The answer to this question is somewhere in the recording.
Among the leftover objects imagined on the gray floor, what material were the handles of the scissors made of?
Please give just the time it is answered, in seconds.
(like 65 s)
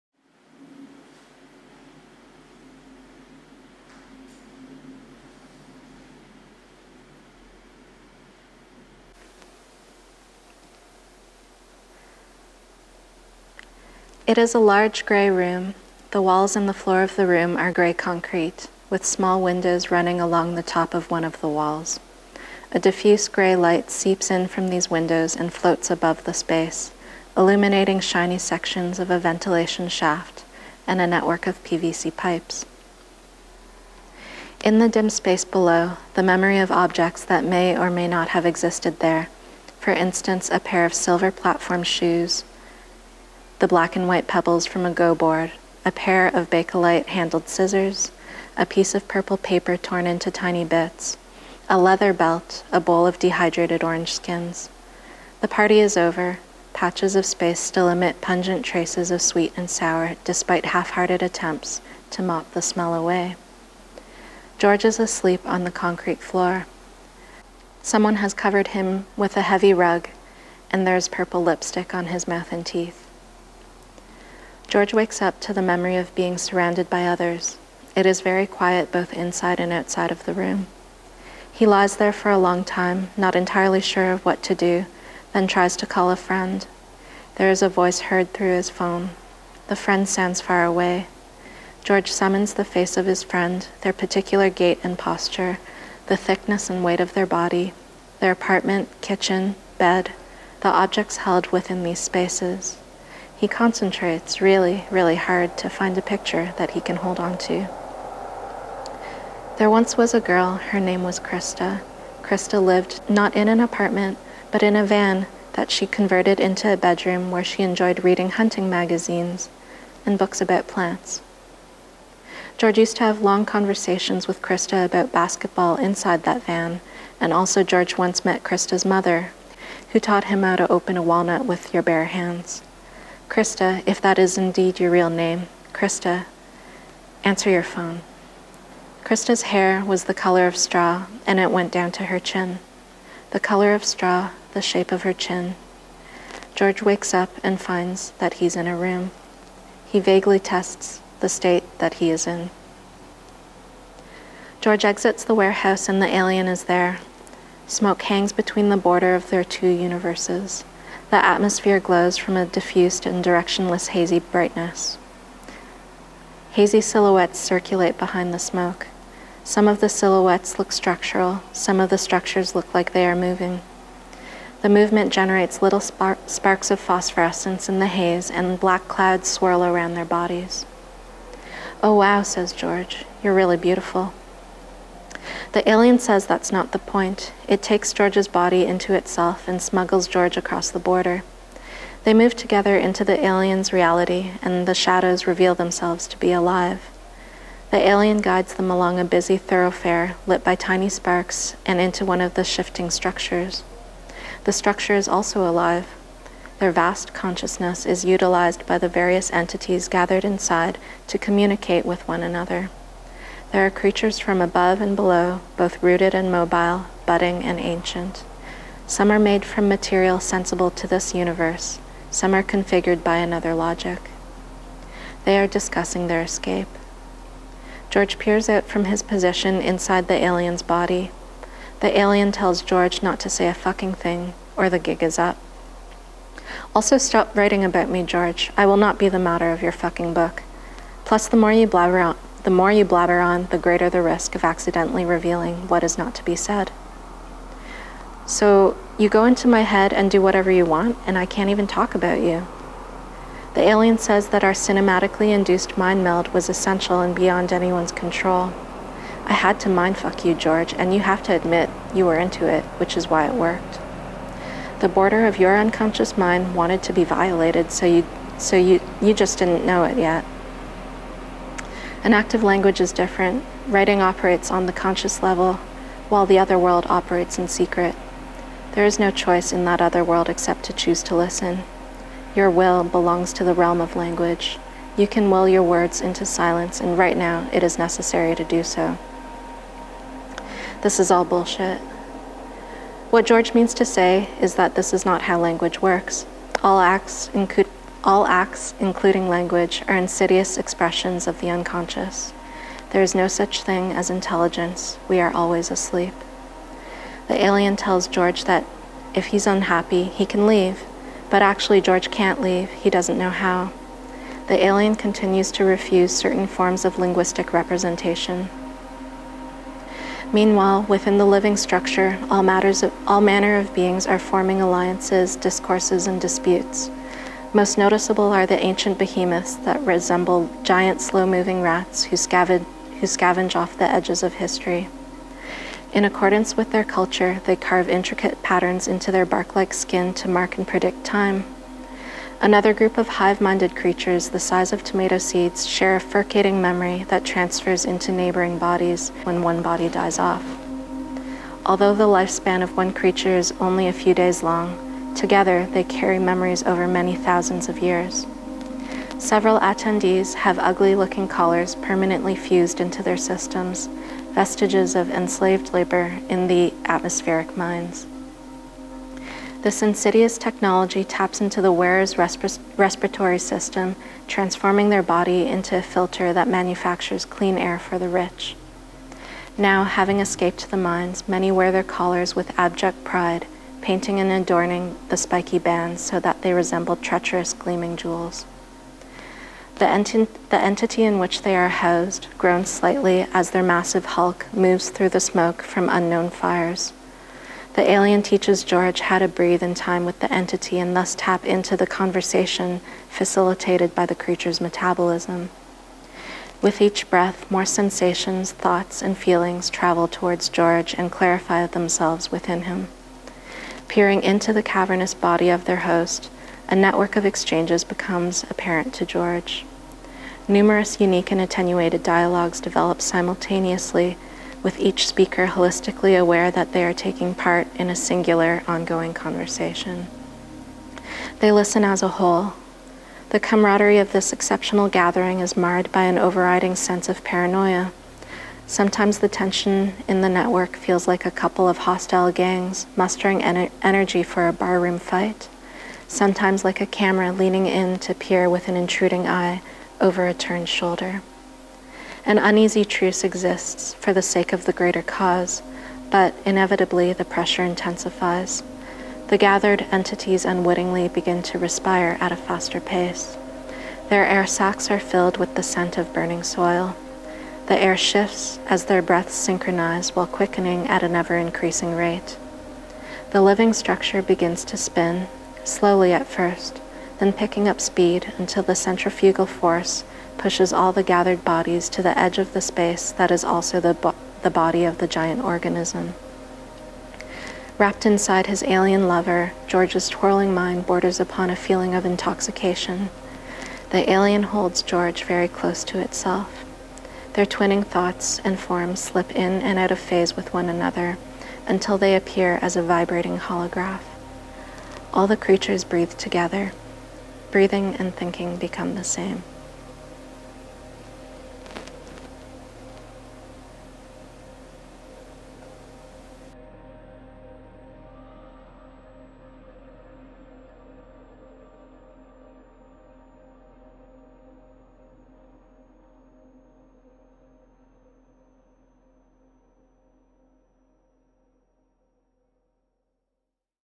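46 s.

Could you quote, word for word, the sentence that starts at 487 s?
Wrapped inside his alien lover, George's twirling mind borders upon a feeling of intoxication.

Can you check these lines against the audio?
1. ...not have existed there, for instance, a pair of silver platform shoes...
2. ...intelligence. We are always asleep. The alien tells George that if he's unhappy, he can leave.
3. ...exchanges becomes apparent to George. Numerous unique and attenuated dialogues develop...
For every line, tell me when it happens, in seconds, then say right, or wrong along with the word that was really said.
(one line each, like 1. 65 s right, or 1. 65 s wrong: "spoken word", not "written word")
1. 38 s right
2. 304 s right
3. 417 s right.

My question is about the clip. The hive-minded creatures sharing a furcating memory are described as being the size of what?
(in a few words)
tomato seeds.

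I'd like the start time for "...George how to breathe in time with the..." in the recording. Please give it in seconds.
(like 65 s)
398 s.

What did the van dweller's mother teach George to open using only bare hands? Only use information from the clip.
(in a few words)
a walnut.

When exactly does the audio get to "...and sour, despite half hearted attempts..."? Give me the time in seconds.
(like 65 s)
59 s.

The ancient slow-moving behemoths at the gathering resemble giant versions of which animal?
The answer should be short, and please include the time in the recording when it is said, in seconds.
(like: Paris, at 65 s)
rats, at 331 s.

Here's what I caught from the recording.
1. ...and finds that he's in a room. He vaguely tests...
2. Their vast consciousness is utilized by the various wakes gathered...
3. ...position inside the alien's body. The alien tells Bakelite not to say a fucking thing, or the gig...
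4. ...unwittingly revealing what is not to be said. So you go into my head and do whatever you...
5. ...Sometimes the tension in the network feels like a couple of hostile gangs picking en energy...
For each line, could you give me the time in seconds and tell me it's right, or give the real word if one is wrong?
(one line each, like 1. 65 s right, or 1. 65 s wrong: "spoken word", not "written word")
1. 147 s right
2. 206 s wrong: "entities", not "wakes"
3. 229 s wrong: "George", not "Bakelite"
4. 244 s wrong: "accidentally", not "unwittingly"
5. 438 s wrong: "mustering", not "picking".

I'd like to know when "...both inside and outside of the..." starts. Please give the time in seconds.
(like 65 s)
78 s.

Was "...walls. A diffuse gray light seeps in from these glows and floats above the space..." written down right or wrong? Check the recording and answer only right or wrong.
wrong.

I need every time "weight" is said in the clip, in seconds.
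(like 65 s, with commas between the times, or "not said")
96 s.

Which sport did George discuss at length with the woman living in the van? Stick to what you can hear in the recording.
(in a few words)
basketball.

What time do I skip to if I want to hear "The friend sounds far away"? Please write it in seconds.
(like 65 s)
89 s.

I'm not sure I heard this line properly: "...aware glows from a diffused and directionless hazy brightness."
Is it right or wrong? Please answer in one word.
wrong.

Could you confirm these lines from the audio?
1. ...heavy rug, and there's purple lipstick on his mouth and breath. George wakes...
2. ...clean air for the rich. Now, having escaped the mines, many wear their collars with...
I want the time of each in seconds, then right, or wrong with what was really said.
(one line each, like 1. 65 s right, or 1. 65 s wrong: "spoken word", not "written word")
1. 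69 s wrong: "teeth", not "breath"
2. 377 s right.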